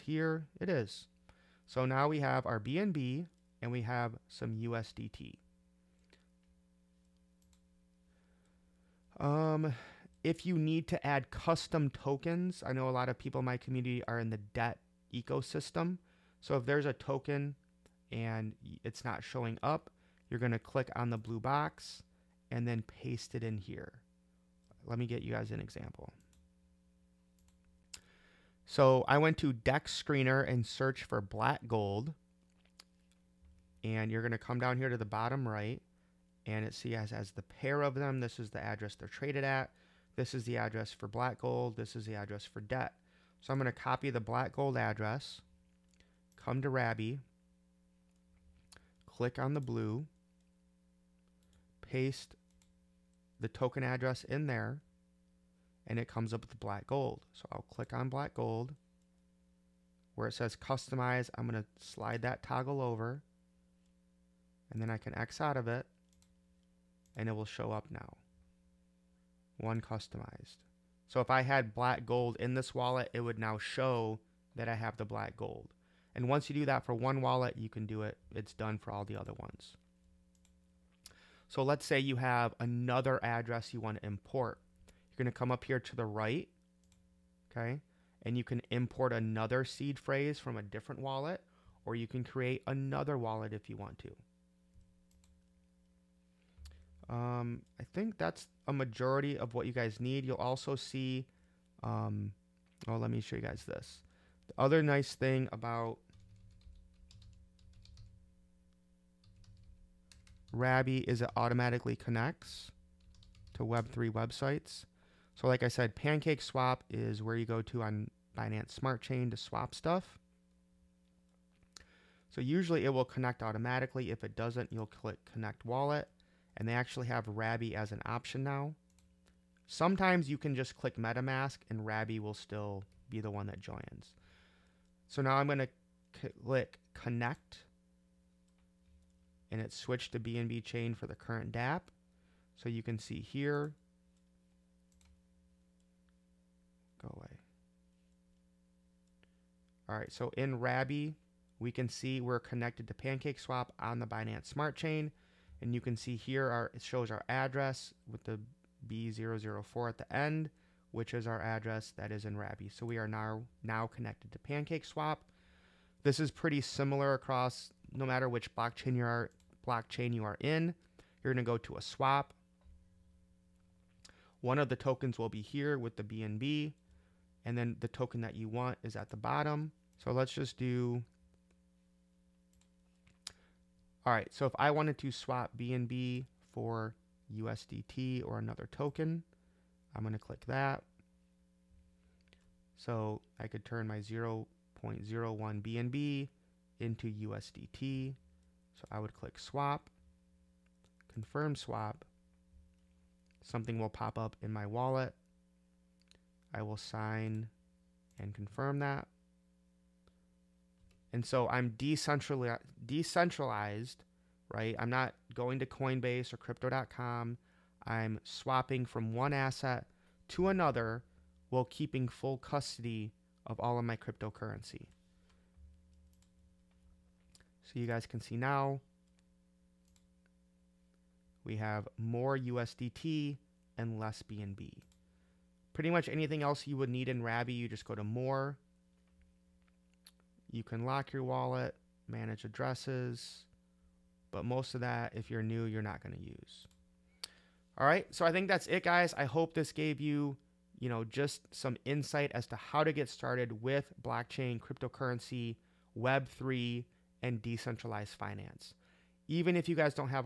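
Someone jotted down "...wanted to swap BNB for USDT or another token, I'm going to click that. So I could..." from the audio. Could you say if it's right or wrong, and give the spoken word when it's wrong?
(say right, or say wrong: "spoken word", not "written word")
right.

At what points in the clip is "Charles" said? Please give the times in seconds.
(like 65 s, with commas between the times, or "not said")
not said.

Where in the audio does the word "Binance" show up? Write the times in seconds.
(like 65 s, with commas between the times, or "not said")
118 s, 154 s.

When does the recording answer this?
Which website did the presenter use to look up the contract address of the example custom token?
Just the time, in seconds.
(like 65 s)
29 s.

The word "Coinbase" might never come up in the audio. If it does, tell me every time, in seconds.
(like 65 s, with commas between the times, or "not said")
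215 s.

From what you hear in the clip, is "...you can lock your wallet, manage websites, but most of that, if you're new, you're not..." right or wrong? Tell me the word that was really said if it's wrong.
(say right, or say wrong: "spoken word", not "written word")
wrong: "addresses", not "websites".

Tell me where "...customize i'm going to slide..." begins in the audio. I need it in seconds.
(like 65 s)
60 s.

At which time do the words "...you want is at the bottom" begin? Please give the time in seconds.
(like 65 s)
178 s.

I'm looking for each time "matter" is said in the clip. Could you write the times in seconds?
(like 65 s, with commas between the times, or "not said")
168 s.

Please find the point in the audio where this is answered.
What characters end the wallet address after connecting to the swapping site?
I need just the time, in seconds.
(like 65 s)
158 s.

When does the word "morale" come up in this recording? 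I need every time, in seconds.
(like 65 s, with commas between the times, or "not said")
not said.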